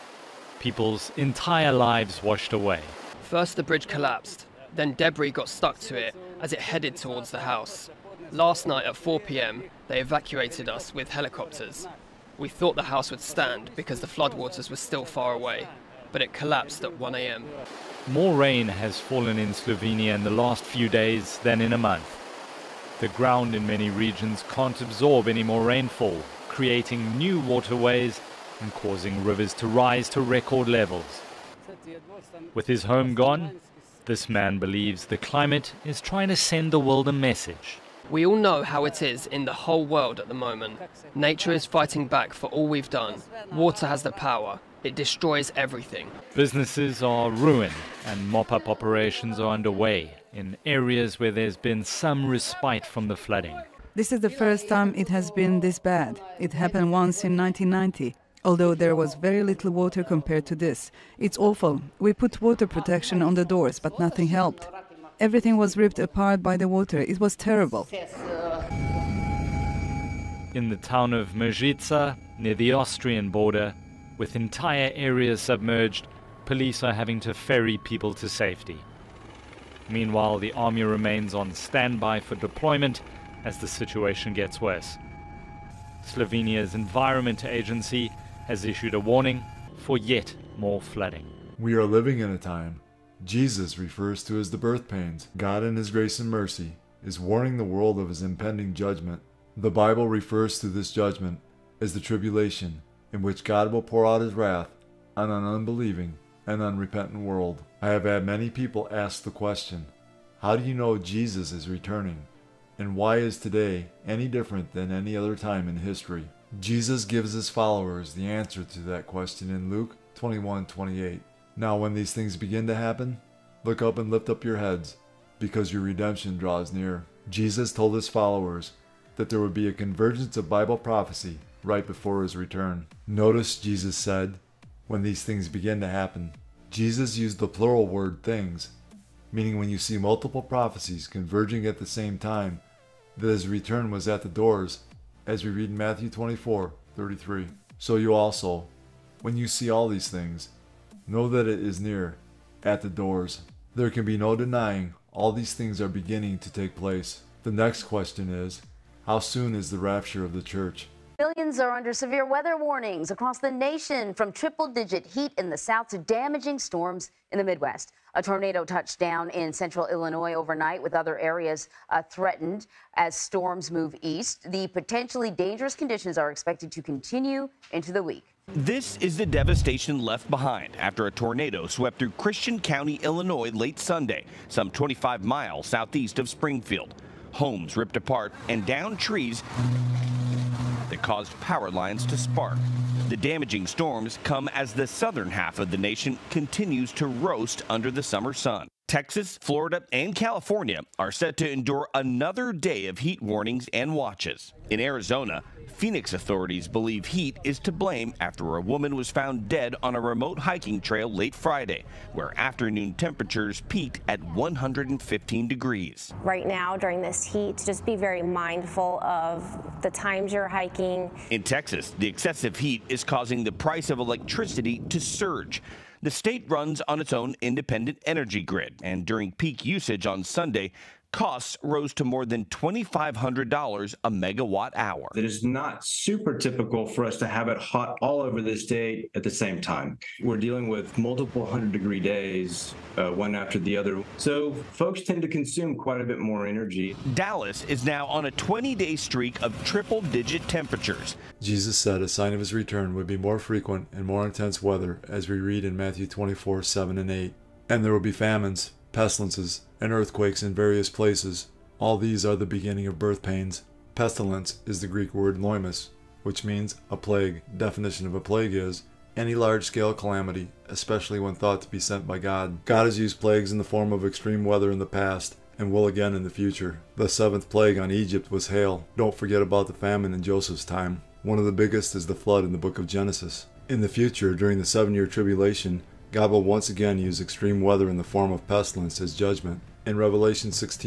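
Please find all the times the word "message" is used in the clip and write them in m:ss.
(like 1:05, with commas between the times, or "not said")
0:37.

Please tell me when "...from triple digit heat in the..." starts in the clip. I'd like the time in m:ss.
2:44.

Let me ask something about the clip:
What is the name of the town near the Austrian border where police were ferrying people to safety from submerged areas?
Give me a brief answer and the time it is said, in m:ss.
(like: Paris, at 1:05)
Mezica, at 1:11.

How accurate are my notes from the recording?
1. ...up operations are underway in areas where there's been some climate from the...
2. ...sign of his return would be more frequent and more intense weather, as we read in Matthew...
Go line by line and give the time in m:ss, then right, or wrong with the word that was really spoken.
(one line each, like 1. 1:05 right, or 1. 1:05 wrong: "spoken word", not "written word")
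1. 0:48 wrong: "respite", not "climate"
2. 4:12 right.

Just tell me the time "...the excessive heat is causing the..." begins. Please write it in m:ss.
3:41.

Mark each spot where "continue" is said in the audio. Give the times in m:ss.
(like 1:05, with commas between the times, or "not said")
2:56, 3:16.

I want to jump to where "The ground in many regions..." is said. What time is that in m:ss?
0:23.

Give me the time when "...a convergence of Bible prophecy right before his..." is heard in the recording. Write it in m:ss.
2:09.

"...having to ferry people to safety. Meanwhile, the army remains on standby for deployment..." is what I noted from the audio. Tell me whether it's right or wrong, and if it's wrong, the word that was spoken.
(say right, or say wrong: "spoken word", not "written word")
right.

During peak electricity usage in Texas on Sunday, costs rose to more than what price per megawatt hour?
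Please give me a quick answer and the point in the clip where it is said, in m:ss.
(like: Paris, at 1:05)
$2,500, at 3:52.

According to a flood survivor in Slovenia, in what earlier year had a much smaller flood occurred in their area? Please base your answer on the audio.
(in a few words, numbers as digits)
1990.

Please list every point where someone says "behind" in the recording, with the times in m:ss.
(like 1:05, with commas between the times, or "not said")
3:00.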